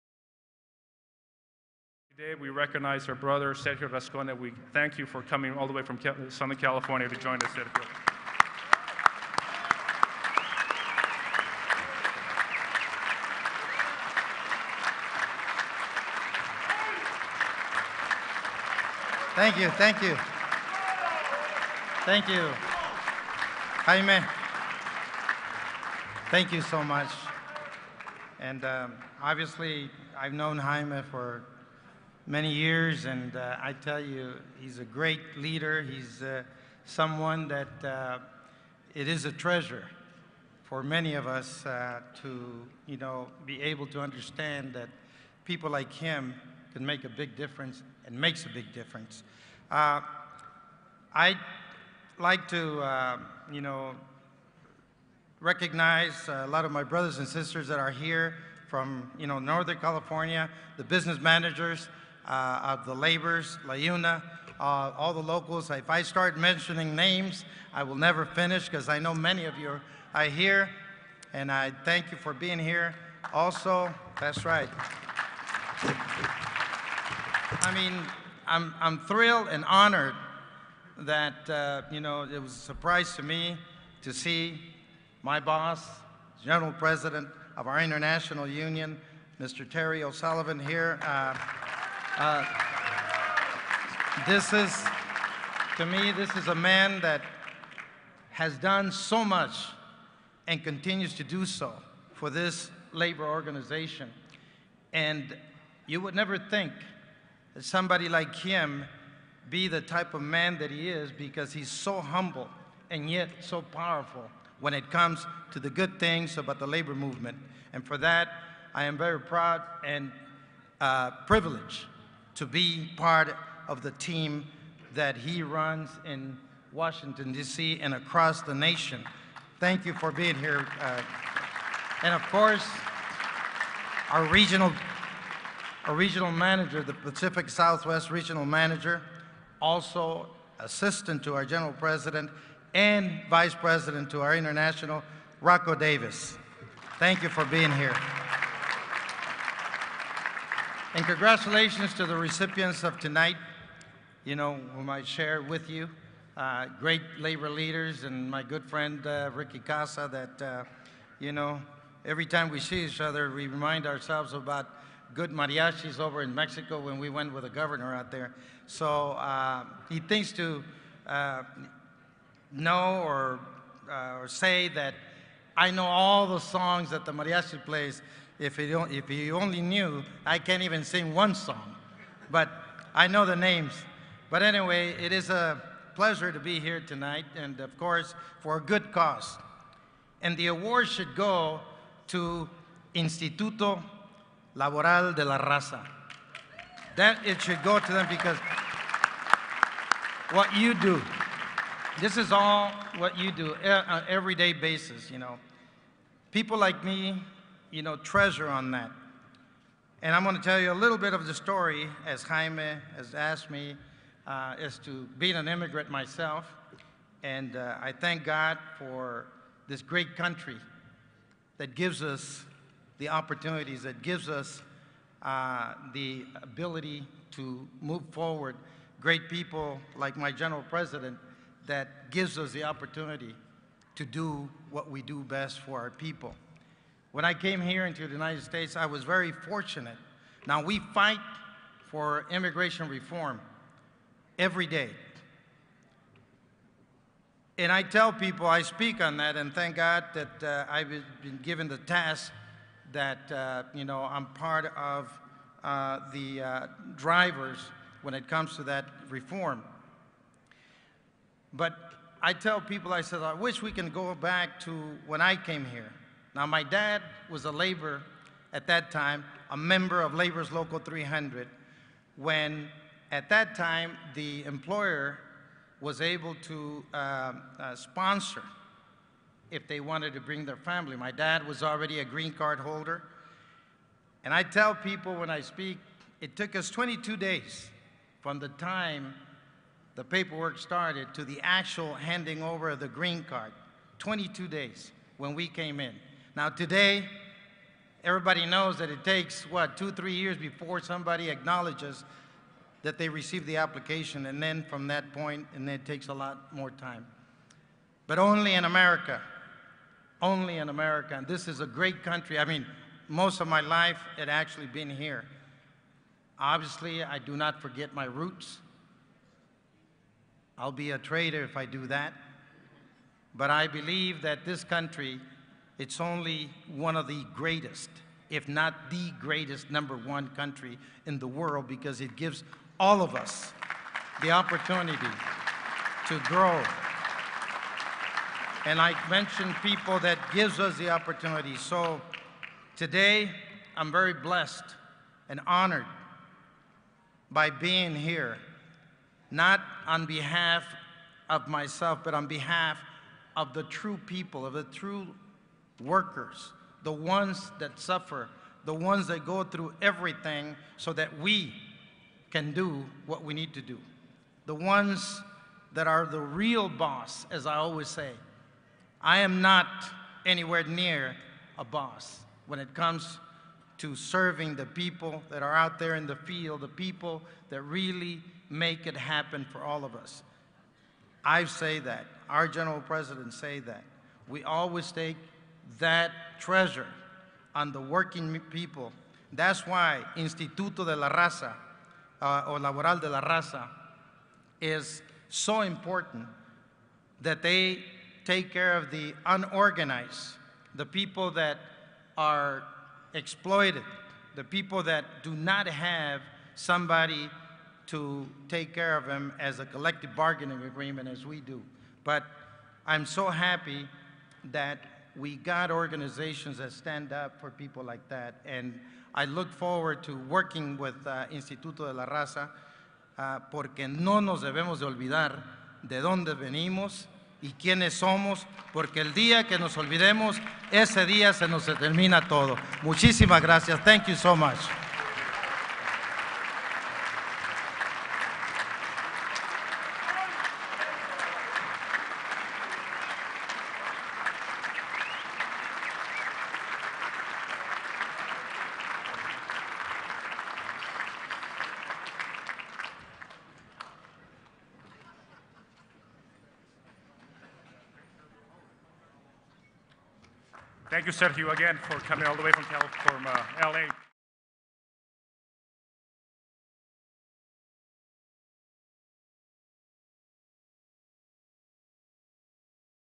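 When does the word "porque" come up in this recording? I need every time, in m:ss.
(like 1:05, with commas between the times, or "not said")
7:03, 7:08.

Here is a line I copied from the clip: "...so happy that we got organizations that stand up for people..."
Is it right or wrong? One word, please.
right.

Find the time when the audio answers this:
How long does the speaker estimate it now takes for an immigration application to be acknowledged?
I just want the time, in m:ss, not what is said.
4:59.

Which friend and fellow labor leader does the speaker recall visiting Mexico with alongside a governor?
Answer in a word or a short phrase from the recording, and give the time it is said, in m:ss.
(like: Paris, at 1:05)
Ricky Casa, at 2:39.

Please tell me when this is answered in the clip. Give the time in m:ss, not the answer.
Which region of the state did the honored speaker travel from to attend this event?
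0:06.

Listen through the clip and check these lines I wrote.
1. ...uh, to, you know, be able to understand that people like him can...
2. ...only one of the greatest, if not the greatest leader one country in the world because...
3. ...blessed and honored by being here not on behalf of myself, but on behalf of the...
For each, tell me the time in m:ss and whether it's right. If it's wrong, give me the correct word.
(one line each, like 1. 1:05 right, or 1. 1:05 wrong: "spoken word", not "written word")
1. 0:41 right
2. 5:26 wrong: "number", not "leader"
3. 5:44 right.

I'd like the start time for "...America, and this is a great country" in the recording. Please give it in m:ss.
5:10.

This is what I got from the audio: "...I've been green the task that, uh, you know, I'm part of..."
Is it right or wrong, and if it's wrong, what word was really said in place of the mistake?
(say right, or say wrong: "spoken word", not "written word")
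wrong: "given", not "green".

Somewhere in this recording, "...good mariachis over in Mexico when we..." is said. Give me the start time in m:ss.
2:45.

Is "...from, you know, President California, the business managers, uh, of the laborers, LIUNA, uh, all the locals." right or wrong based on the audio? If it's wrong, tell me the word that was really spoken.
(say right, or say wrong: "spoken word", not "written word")
wrong: "Northern", not "President".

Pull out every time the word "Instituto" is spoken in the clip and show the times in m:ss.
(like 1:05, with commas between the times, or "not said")
3:12, 6:30, 7:01.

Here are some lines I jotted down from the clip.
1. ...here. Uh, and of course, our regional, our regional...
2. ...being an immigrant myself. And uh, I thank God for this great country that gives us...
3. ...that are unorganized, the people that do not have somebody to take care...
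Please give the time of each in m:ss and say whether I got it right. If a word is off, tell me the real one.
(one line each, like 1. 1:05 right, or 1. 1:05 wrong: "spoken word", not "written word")
1. 2:10 right
2. 3:35 right
3. 6:41 wrong: "exploited", not "unorganized".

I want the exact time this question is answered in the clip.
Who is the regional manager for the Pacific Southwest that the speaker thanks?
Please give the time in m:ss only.
2:25.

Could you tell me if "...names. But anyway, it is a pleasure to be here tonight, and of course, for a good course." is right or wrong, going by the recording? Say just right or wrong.
wrong.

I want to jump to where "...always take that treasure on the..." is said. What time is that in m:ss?
6:24.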